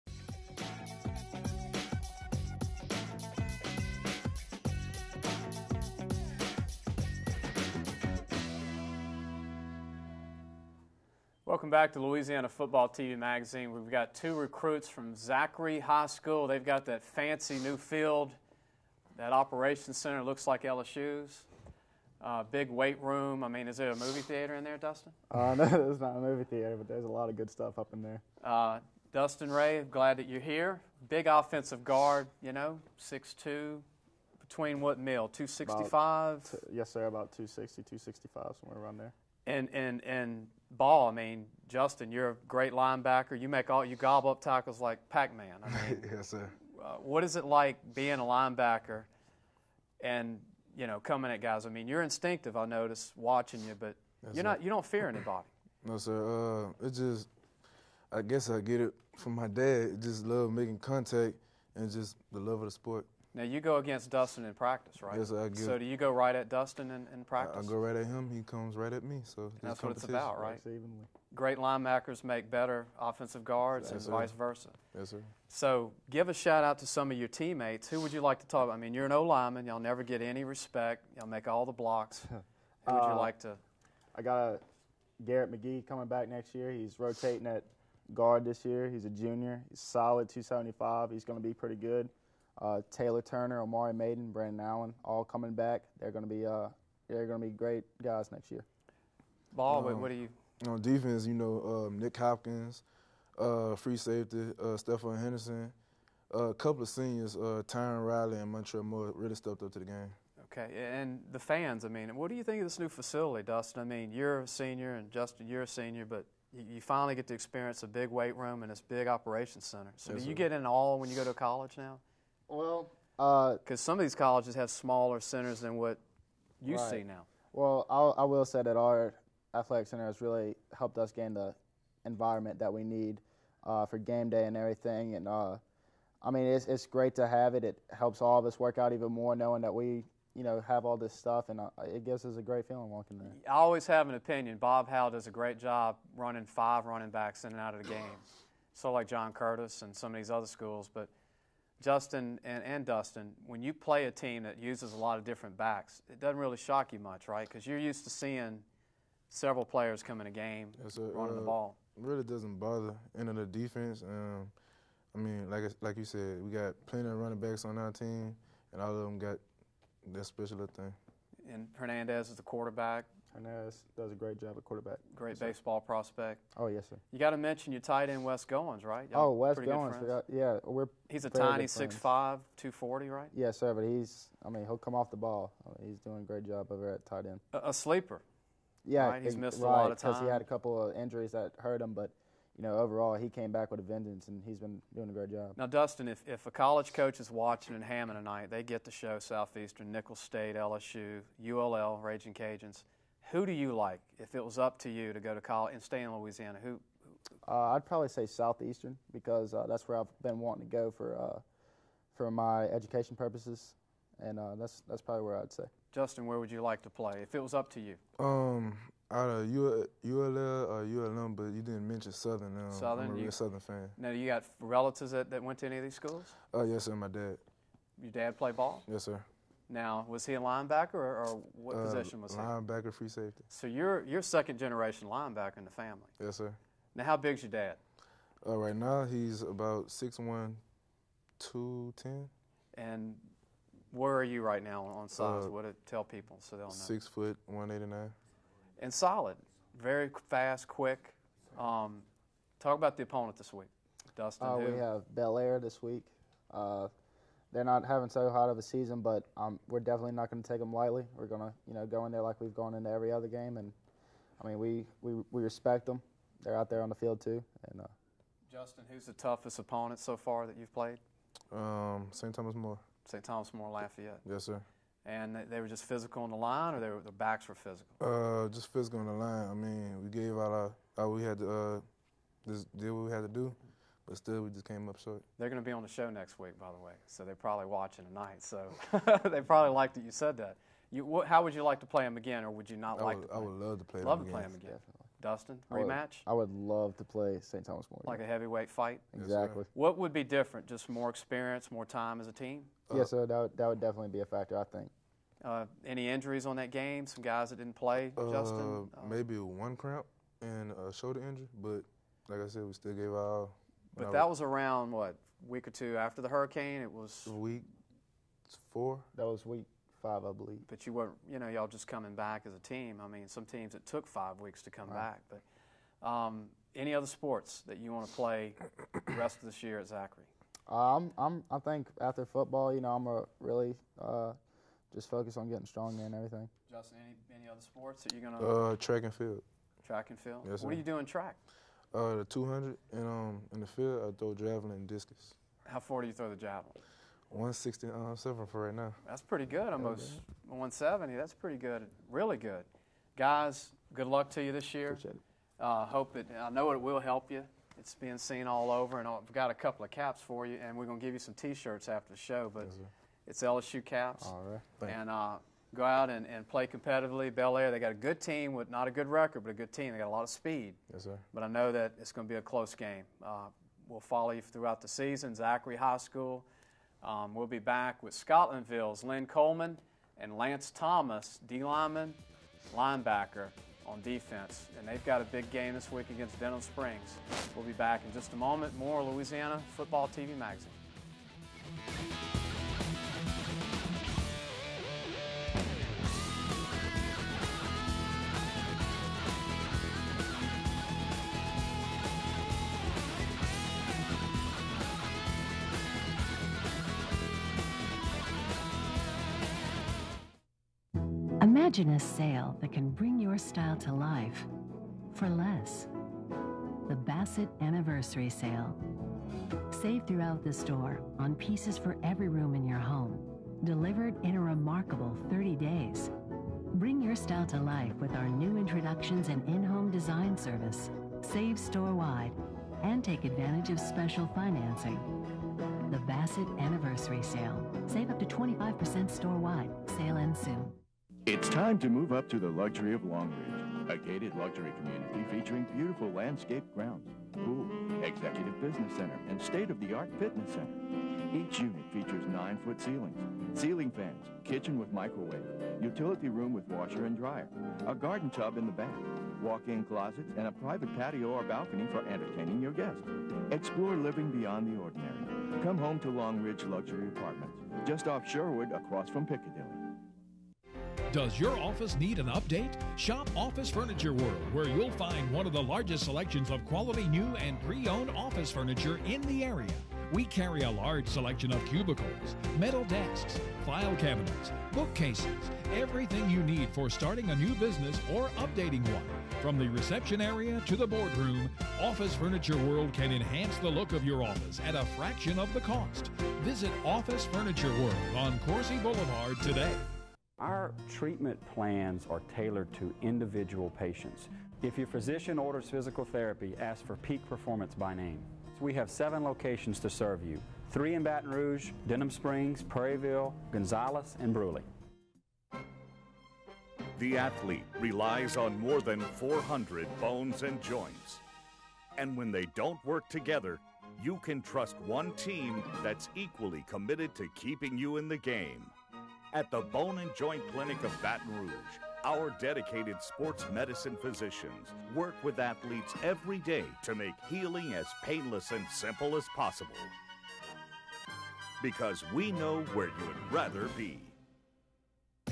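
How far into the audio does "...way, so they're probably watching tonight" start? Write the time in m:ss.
4:46.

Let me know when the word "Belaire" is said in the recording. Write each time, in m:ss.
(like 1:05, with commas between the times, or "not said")
4:15, 6:07.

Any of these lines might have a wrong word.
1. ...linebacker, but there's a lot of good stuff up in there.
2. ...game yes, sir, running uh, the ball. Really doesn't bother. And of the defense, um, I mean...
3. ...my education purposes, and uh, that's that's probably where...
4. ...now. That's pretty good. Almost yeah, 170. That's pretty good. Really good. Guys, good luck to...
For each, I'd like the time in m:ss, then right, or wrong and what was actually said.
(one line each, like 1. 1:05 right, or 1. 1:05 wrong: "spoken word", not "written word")
1. 0:26 wrong: "theater", not "linebacker"
2. 2:40 right
3. 3:32 right
4. 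5:48 right.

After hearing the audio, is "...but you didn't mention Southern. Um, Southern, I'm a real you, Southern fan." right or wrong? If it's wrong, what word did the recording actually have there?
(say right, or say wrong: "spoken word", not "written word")
right.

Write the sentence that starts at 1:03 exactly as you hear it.
Now you go against Dustin in practice, right?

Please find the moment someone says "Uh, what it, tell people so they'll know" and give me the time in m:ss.
4:05.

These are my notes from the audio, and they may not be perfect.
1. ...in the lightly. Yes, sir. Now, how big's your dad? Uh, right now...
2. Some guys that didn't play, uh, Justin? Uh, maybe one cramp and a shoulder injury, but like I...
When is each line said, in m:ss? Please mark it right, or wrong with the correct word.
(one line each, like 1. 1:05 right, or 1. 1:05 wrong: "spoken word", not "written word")
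1. 3:55 wrong: "family", not "lightly"
2. 5:07 right.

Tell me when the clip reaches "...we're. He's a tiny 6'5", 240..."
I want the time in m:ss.
3:00.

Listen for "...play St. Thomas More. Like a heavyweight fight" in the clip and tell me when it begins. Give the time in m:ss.
4:57.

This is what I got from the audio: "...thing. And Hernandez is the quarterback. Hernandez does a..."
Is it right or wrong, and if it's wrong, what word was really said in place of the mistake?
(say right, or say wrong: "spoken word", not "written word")
right.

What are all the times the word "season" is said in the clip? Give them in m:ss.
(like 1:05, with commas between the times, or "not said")
4:18, 6:14.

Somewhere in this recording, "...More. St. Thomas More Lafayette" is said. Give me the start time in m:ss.
4:32.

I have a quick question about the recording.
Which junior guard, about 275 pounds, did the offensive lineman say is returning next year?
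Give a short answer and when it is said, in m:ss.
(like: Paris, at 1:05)
Garrett McGee, at 1:25.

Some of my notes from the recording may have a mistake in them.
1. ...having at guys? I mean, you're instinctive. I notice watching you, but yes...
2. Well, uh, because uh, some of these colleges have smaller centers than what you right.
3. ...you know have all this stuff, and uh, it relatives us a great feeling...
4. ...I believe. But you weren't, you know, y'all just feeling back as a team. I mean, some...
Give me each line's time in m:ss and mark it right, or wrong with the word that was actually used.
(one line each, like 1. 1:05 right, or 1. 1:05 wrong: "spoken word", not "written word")
1. 0:50 wrong: "coming", not "having"
2. 2:02 right
3. 2:20 wrong: "gives", not "relatives"
4. 5:20 wrong: "coming", not "feeling".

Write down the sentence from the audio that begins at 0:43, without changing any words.
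You make all you gobble up tackles like Pac-Man.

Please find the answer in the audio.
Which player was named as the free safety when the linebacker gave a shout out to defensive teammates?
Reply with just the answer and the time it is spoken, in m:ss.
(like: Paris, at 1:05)
Nick Hopkins, at 1:41.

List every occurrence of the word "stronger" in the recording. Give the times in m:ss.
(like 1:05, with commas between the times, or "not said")
5:35.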